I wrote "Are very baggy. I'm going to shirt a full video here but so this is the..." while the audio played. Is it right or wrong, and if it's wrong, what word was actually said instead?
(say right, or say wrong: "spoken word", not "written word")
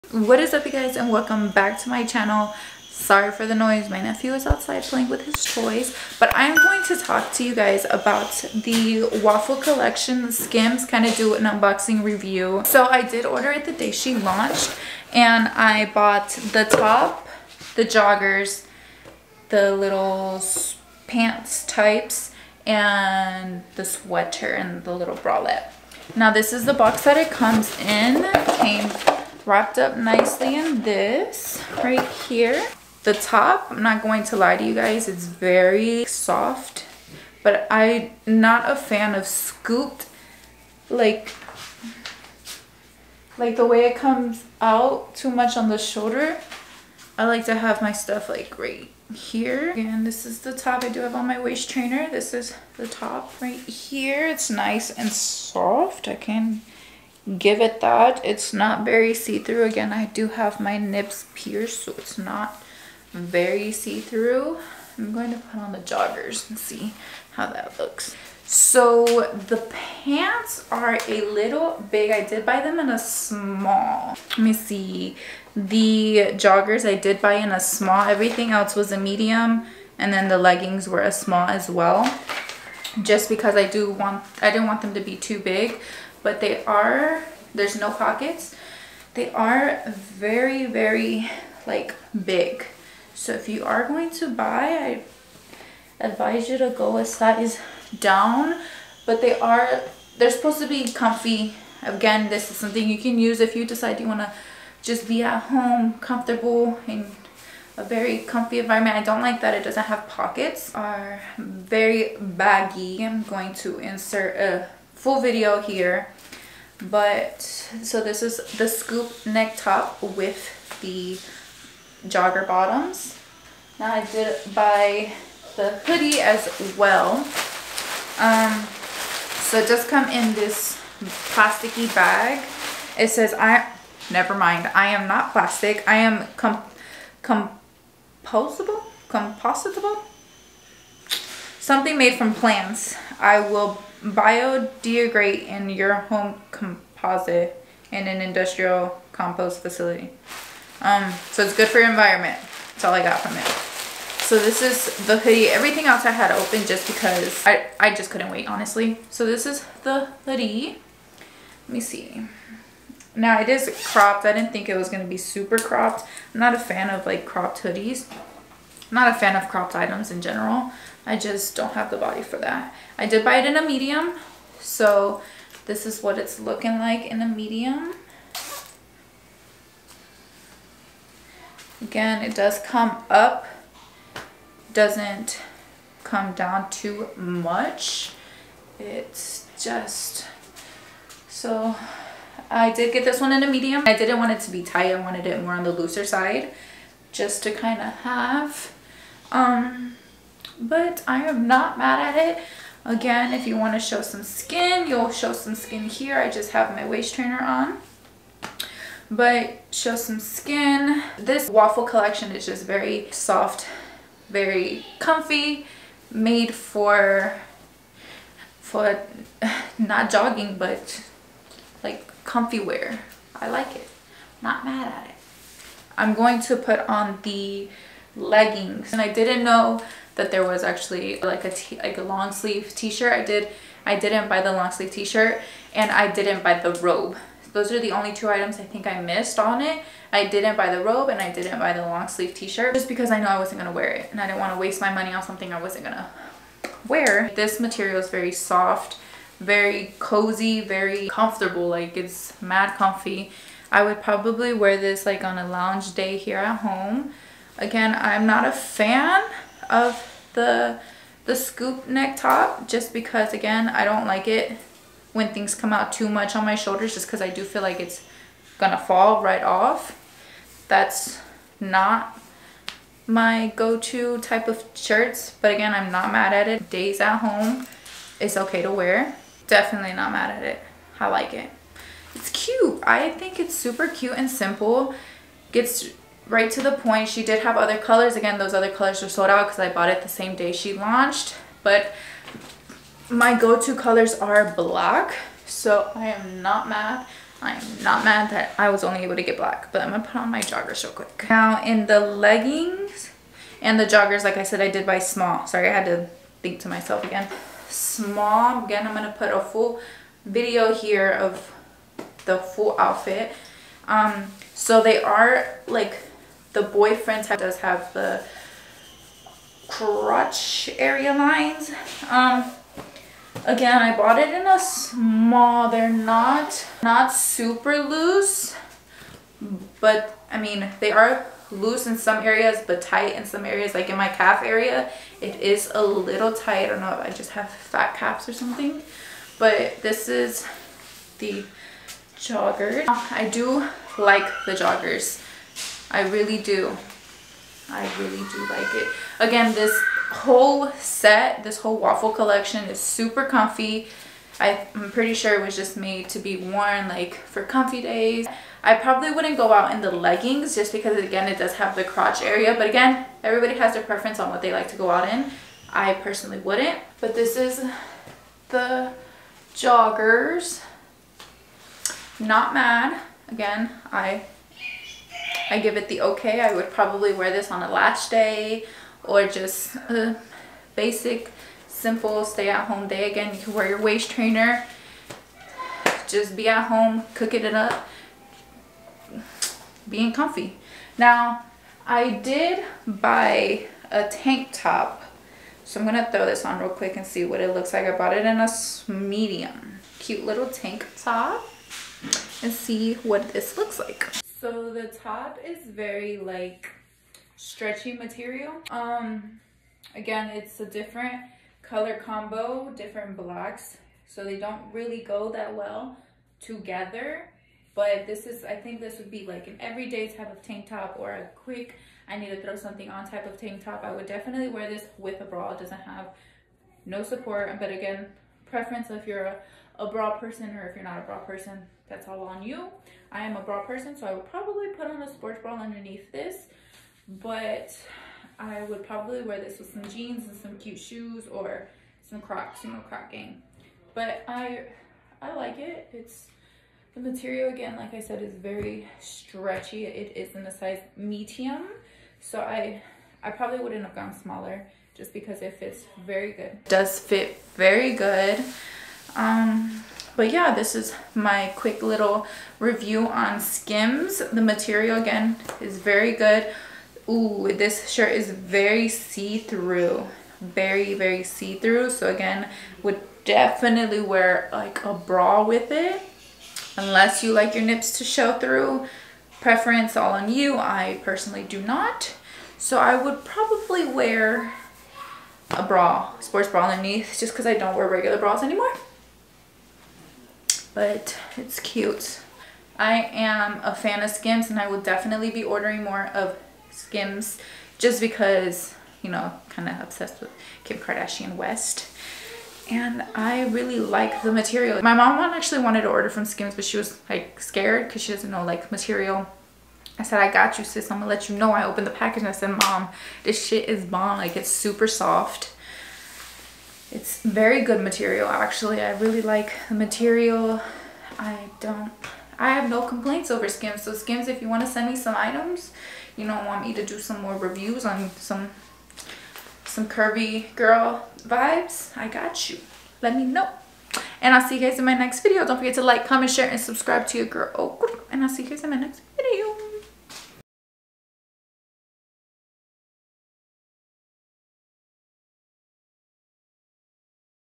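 wrong: "insert", not "shirt".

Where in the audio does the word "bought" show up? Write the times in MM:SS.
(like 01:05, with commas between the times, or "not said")
00:15, 04:49, 05:23, 06:37.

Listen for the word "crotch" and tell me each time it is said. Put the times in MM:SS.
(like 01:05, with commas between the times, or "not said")
05:19, 06:01.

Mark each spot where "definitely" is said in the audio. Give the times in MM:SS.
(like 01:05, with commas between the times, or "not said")
04:39, 07:04, 07:53, 08:14.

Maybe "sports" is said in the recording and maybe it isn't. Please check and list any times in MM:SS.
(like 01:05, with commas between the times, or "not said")
07:15, 08:06.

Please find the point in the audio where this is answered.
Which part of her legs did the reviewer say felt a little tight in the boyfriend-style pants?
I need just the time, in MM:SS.
05:33.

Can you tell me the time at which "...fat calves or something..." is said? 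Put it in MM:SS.
05:37.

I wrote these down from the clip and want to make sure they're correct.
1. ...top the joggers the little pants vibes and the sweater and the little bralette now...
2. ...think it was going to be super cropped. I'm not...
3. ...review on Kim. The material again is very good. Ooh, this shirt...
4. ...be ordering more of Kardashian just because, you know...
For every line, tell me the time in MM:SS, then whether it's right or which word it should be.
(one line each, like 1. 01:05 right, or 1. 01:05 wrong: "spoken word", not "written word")
1. 00:16 wrong: "types", not "vibes"
2. 02:44 right
3. 07:42 wrong: "Skims", not "Kim"
4. 08:15 wrong: "Skims", not "Kardashian".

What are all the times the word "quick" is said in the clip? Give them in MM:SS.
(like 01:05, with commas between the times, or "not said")
05:00, 06:36, 07:01, 07:41.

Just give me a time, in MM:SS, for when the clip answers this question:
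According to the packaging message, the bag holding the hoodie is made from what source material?
02:21.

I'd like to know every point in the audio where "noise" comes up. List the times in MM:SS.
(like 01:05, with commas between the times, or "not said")
00:03.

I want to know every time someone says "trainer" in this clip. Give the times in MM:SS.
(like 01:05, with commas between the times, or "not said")
00:51, 03:27, 06:24.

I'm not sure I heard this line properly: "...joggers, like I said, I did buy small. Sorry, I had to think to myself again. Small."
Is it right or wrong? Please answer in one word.
right.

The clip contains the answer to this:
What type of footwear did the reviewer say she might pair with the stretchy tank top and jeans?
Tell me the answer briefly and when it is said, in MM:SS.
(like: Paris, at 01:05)
Crocs, at 07:22.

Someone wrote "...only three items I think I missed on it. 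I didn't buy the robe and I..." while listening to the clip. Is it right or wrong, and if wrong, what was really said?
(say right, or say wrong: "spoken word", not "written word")
wrong: "two", not "three".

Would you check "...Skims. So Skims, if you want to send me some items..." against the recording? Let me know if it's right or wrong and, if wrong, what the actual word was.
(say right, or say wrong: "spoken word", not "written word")
right.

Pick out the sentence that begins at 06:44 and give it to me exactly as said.
So the top is very like stretchy material.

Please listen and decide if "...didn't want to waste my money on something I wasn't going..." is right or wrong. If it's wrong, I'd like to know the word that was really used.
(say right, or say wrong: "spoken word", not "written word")
right.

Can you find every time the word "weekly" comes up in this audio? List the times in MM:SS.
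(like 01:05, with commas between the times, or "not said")
not said.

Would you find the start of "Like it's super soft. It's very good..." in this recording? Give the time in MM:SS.
08:34.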